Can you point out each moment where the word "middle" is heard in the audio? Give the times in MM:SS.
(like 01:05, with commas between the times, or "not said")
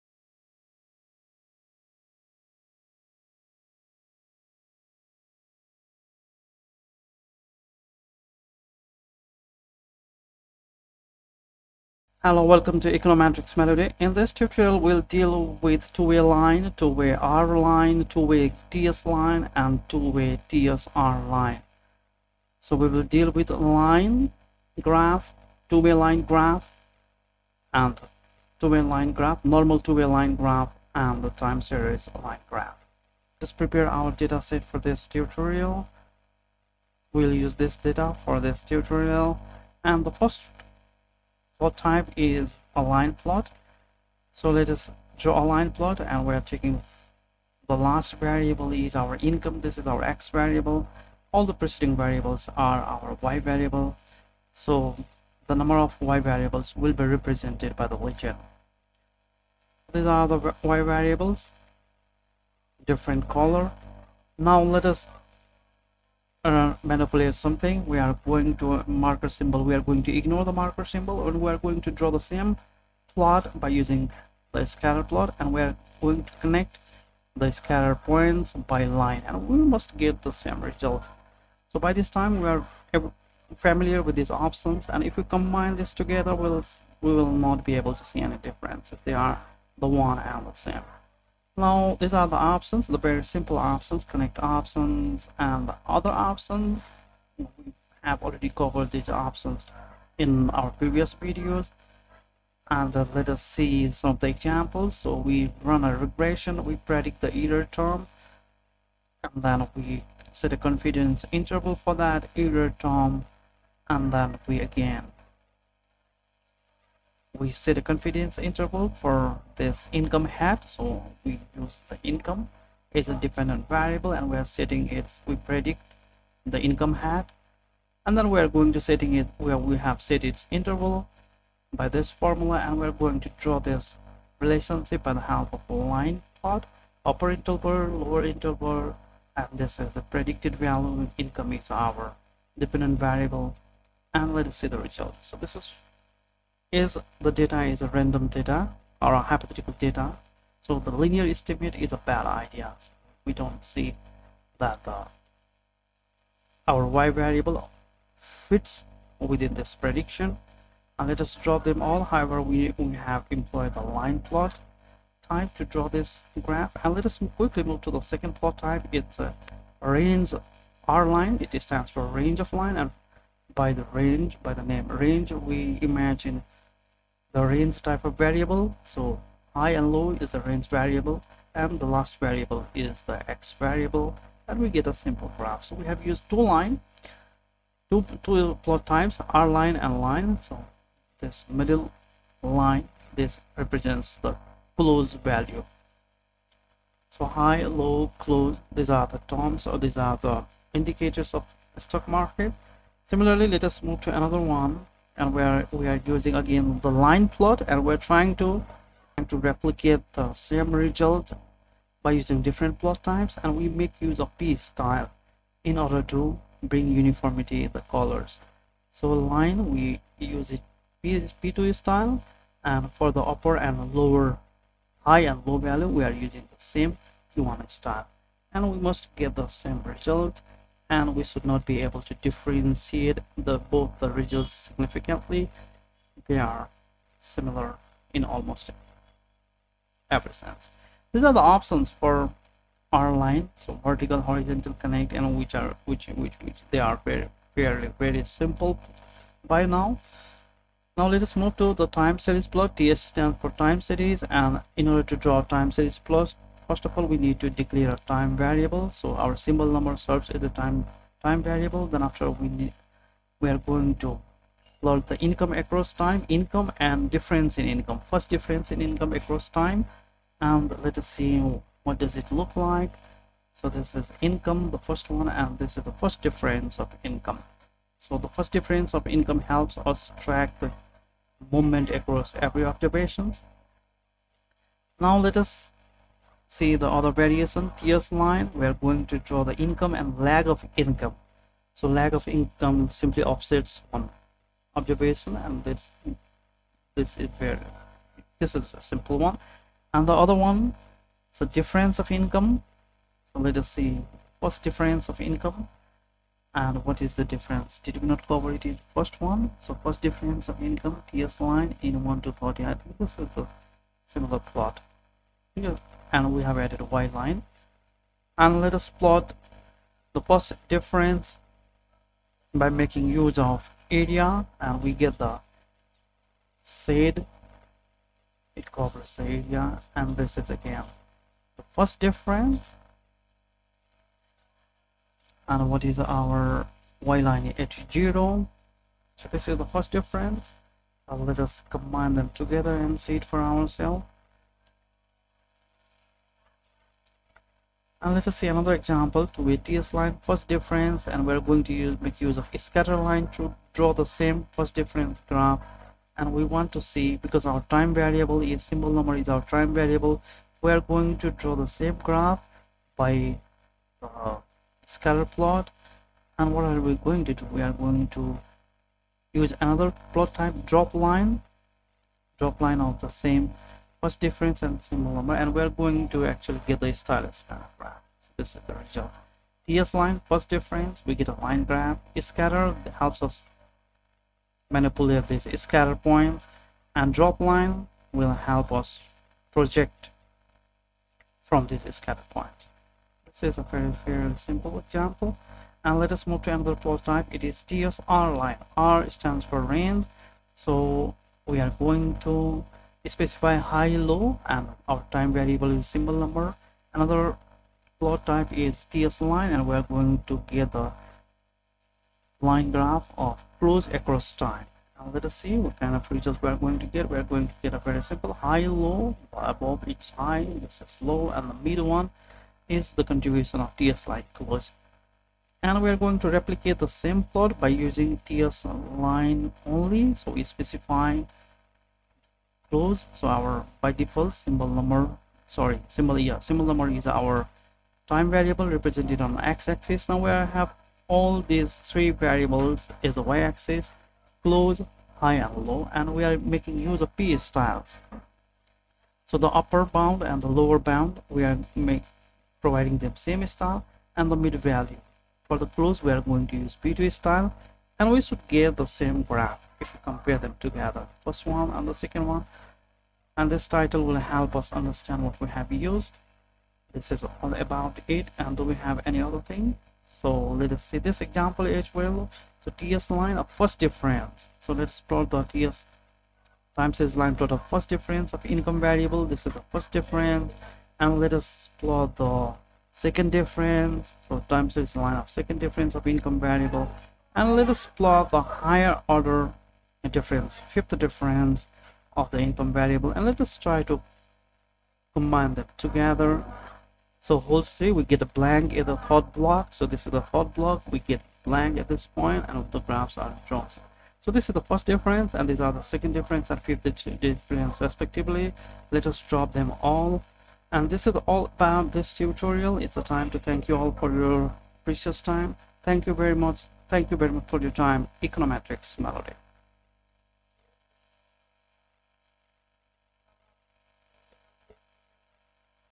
03:11, 07:01.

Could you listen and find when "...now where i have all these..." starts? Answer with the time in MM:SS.
07:20.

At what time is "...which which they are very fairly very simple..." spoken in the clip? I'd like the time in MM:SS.
04:06.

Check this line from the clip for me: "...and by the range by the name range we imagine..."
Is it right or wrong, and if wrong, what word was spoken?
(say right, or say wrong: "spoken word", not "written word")
right.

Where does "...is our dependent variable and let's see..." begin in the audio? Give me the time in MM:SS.
02:21.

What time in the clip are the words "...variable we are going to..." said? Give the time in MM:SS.
05:59.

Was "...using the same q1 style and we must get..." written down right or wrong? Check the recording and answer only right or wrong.
right.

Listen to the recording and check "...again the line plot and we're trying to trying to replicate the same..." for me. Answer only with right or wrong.
right.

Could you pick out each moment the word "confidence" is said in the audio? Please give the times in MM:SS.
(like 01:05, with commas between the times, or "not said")
01:50, 01:57.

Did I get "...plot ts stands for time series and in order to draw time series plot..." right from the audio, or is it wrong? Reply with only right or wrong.
right.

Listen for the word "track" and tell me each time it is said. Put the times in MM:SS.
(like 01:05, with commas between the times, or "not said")
04:40.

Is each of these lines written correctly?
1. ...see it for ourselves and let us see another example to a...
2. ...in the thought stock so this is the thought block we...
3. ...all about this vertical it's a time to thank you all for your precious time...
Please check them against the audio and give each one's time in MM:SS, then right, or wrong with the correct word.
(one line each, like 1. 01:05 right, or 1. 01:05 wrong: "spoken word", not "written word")
1. 05:42 right
2. 08:18 wrong: "block", not "stock"
3. 08:31 wrong: "tutorial", not "vertical".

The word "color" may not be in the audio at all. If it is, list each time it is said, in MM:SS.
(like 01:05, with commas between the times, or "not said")
01:03, 03:37.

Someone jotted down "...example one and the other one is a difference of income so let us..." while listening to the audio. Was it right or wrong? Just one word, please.
wrong.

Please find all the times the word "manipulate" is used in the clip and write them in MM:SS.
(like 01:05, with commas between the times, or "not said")
01:06, 06:24.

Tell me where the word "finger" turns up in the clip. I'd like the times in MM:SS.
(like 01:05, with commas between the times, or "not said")
not said.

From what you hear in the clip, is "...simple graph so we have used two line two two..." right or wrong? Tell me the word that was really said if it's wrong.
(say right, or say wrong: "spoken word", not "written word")
right.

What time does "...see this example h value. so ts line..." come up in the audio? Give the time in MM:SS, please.
07:50.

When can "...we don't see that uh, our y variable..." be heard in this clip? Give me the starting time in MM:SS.
02:33.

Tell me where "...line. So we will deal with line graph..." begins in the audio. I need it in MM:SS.
00:21.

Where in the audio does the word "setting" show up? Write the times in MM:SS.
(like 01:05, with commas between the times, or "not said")
02:04, 02:08.